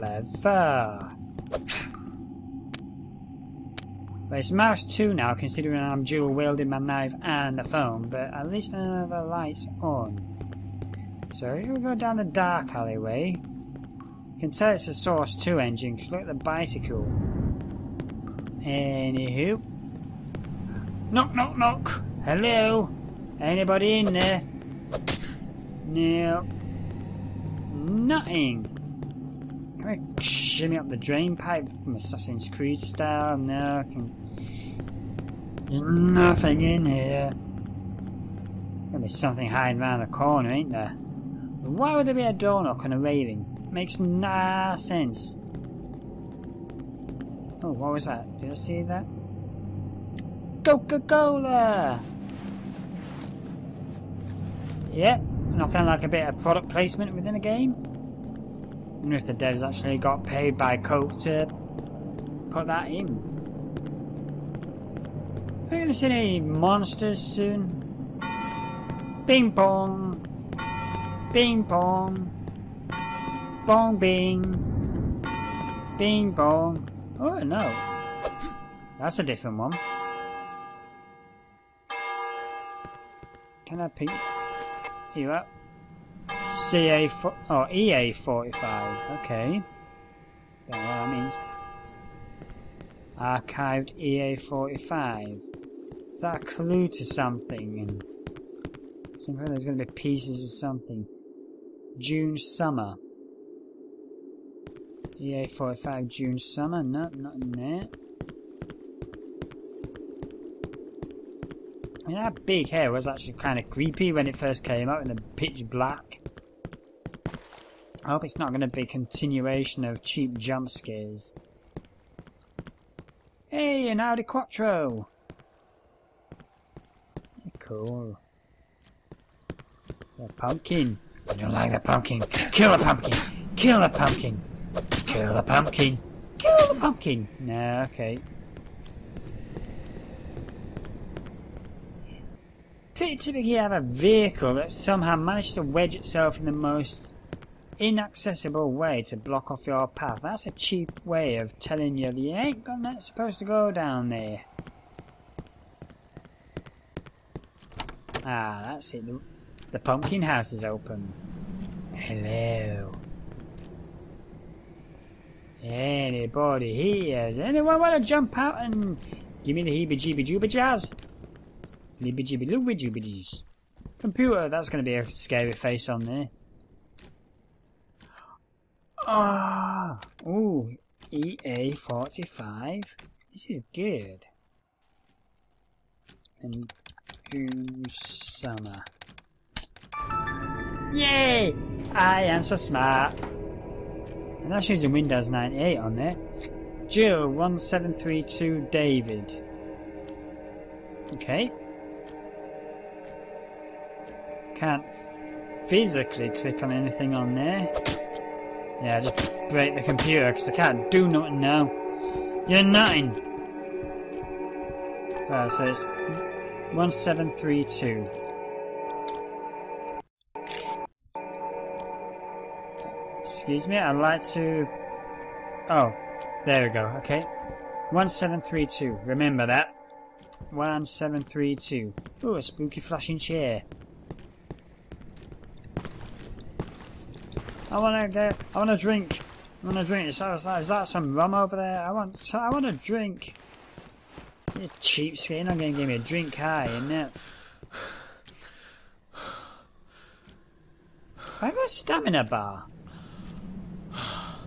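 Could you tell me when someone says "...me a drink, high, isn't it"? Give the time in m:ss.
4:05.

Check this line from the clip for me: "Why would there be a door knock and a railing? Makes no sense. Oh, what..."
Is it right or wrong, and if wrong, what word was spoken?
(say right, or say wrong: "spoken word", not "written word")
right.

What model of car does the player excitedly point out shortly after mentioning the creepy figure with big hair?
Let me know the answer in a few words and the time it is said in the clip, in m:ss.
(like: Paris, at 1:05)
Audi Quattro, at 2:03.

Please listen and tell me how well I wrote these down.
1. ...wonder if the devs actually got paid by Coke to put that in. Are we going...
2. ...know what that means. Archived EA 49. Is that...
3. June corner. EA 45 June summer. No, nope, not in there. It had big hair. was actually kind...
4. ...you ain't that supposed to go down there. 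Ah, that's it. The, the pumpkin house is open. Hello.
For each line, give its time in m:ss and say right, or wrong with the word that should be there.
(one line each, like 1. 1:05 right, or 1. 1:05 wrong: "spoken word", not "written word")
1. 0:59 right
2. 1:30 wrong: "45", not "49"
3. 1:41 wrong: "summer", not "corner"
4. 2:32 right.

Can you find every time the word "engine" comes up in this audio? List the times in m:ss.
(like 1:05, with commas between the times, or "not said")
0:15.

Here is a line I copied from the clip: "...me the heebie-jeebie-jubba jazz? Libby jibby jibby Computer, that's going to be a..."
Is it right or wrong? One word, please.
right.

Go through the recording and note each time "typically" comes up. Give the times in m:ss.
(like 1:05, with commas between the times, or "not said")
2:23.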